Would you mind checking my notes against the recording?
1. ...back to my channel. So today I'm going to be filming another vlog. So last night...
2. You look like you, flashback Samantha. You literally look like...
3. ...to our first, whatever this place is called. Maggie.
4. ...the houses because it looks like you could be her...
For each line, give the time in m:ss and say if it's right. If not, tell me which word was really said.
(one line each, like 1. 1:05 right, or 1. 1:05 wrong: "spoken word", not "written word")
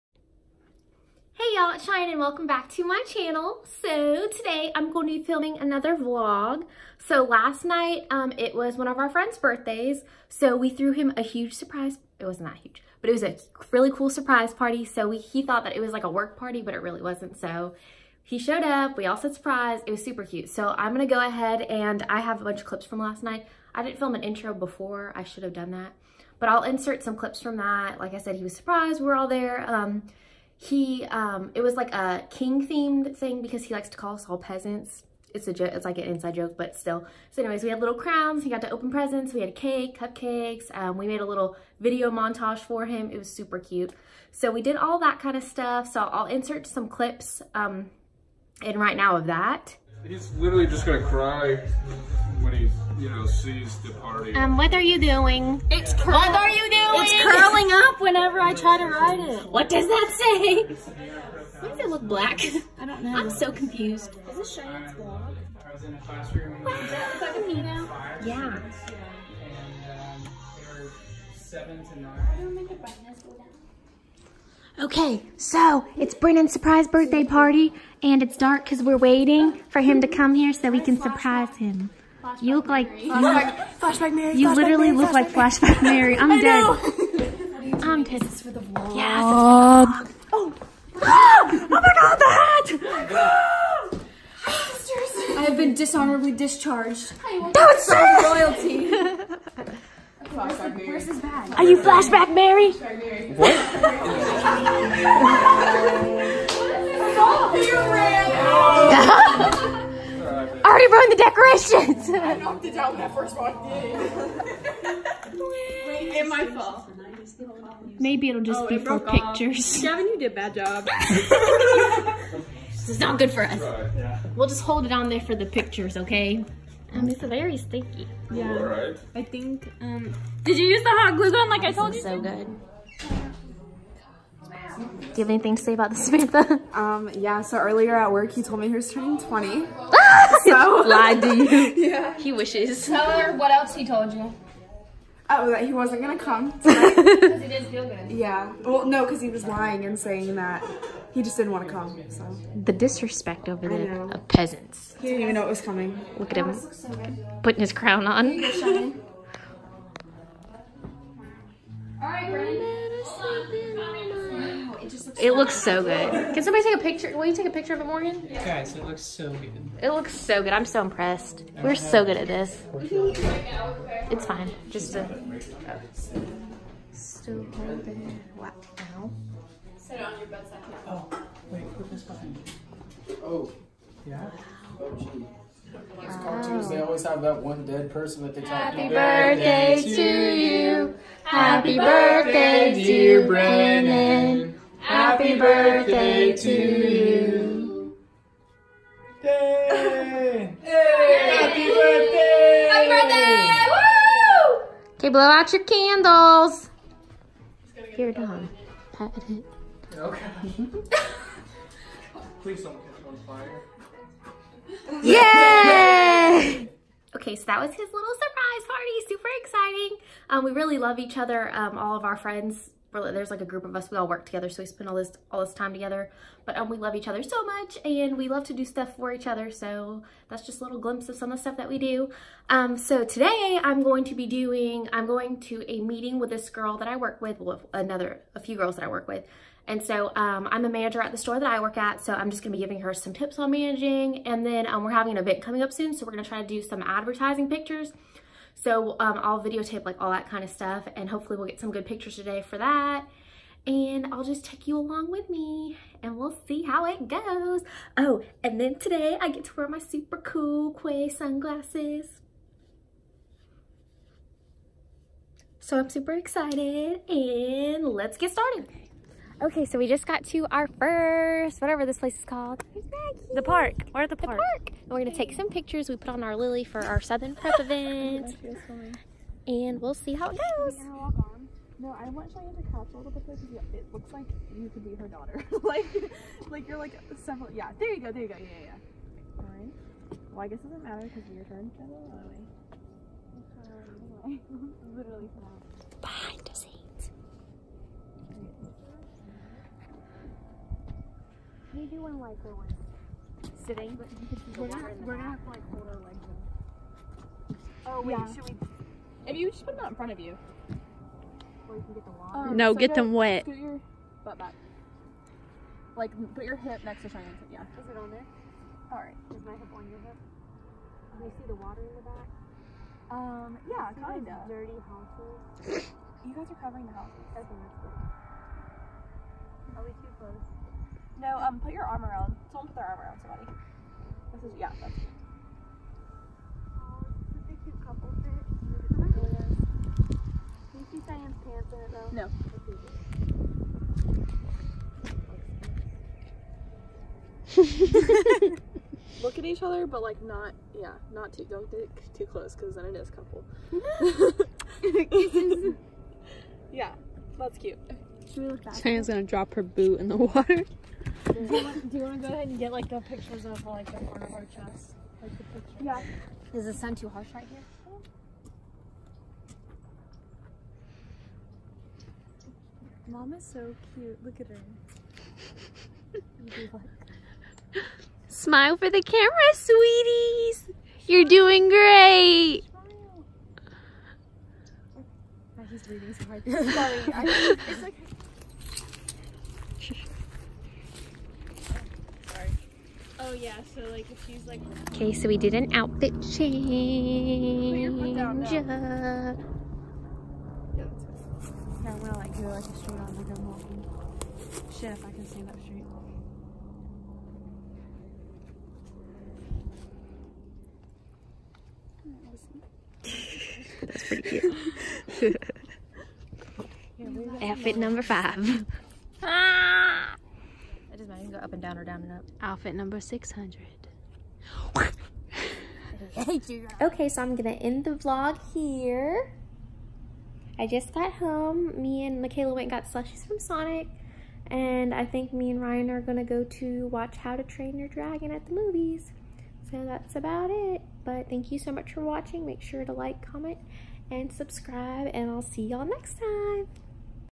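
1. 0:02 right
2. 1:22 wrong: "Mary", not "Samantha"
3. 4:30 right
4. 4:43 wrong: "pictures", not "houses".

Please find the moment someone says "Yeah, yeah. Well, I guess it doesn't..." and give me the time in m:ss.
4:48.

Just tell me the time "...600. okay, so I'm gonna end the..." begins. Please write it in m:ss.
7:02.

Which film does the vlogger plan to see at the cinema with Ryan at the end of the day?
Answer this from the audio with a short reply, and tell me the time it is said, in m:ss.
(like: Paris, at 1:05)
How to Train Your Dragon, at 7:17.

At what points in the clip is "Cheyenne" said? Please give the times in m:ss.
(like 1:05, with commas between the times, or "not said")
1:04, 4:42, 5:17.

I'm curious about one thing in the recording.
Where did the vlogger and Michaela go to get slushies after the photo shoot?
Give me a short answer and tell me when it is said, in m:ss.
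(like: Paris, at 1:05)
Sonic, at 7:13.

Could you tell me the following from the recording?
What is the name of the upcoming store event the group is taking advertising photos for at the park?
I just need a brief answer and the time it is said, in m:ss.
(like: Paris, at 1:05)
Southern Prep, at 4:37.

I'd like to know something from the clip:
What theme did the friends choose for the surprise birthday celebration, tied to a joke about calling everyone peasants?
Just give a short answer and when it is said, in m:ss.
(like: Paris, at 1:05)
King themed, at 0:32.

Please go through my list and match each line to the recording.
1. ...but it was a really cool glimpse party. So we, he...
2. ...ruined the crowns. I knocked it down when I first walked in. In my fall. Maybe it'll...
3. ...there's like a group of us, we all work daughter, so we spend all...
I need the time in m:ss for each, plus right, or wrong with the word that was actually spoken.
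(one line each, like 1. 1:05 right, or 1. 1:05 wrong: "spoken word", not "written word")
1. 0:12 wrong: "surprise", not "glimpse"
2. 1:50 wrong: "decorations", not "crowns"
3. 3:42 wrong: "together", not "daughter".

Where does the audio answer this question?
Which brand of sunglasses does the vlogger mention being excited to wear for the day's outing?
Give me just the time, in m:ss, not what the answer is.
4:20.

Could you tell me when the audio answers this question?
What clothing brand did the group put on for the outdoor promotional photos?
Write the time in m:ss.
4:36.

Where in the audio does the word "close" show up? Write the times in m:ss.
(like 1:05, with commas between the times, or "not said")
5:30, 5:52.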